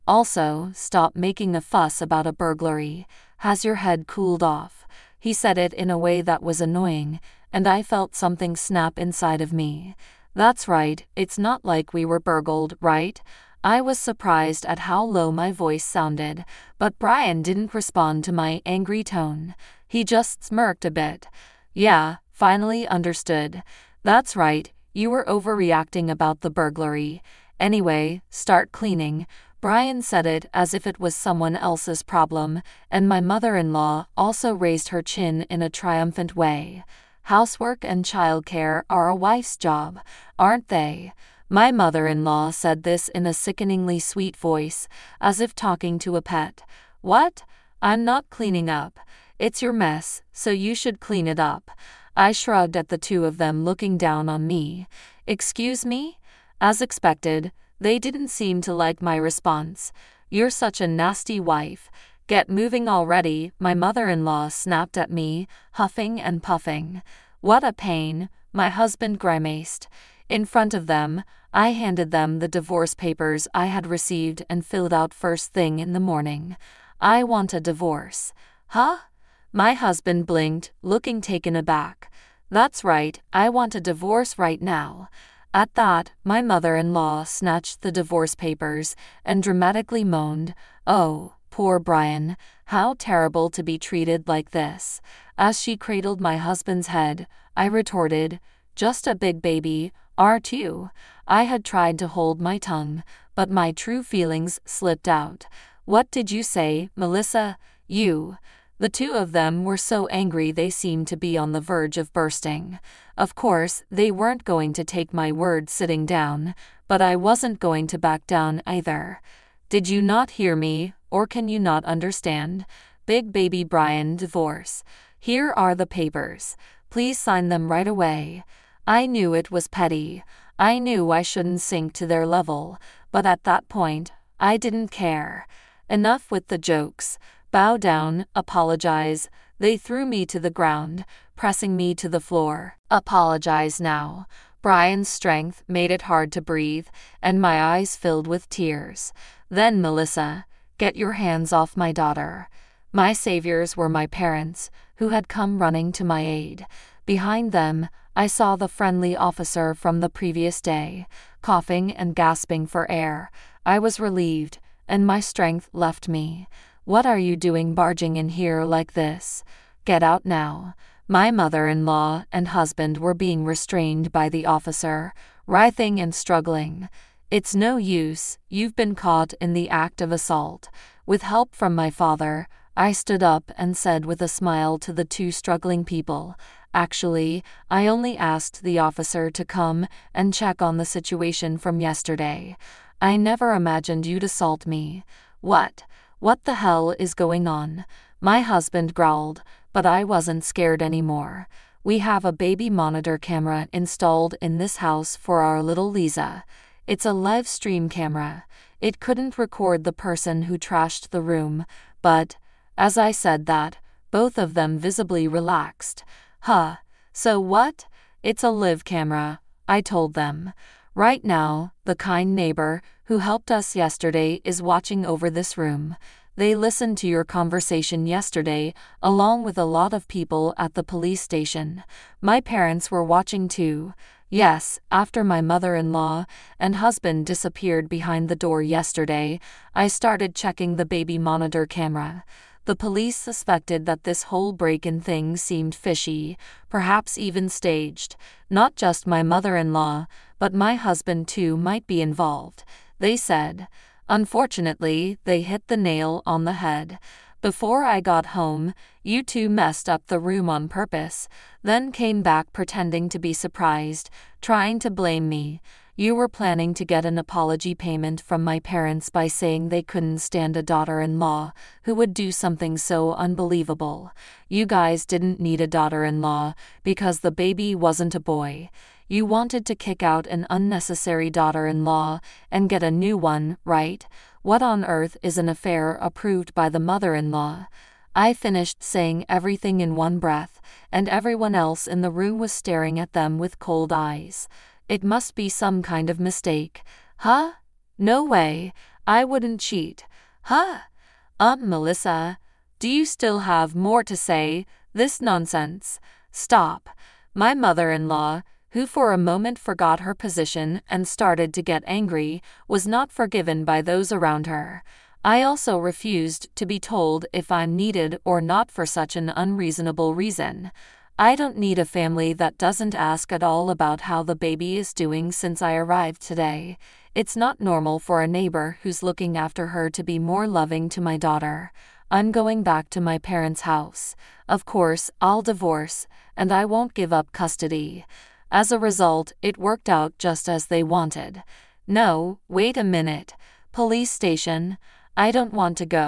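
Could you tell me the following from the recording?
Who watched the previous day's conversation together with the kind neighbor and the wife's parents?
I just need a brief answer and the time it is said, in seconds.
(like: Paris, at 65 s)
people at the police station, at 230 s.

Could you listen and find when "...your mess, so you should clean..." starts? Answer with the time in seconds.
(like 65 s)
49 s.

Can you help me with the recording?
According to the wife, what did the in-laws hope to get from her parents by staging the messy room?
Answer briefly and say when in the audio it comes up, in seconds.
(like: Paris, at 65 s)
apology payment, at 267 s.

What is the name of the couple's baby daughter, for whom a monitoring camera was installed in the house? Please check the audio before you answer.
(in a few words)
Lisa.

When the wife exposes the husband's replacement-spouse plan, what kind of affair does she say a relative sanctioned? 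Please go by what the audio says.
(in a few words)
affair approved by the mother in law.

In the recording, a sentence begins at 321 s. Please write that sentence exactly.
I don't need a family that doesn't ask at all about how the baby is doing since I arrived today.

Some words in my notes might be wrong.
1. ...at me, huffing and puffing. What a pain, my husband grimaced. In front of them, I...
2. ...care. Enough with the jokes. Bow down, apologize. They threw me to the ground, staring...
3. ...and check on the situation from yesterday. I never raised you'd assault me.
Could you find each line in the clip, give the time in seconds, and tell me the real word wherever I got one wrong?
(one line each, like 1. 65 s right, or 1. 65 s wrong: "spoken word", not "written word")
1. 64 s right
2. 134 s wrong: "pressing", not "staring"
3. 190 s wrong: "imagined", not "raised".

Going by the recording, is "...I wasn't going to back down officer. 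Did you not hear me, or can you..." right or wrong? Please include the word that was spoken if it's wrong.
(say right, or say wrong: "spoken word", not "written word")
wrong: "either", not "officer".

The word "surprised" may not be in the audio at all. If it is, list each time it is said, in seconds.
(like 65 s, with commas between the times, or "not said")
13 s, 263 s.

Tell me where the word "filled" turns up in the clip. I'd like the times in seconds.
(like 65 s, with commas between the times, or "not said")
74 s, 147 s.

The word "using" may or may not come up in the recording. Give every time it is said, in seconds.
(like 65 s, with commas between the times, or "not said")
not said.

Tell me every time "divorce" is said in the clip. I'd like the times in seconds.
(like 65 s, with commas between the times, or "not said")
72 s, 77 s, 83 s, 87 s, 124 s, 335 s.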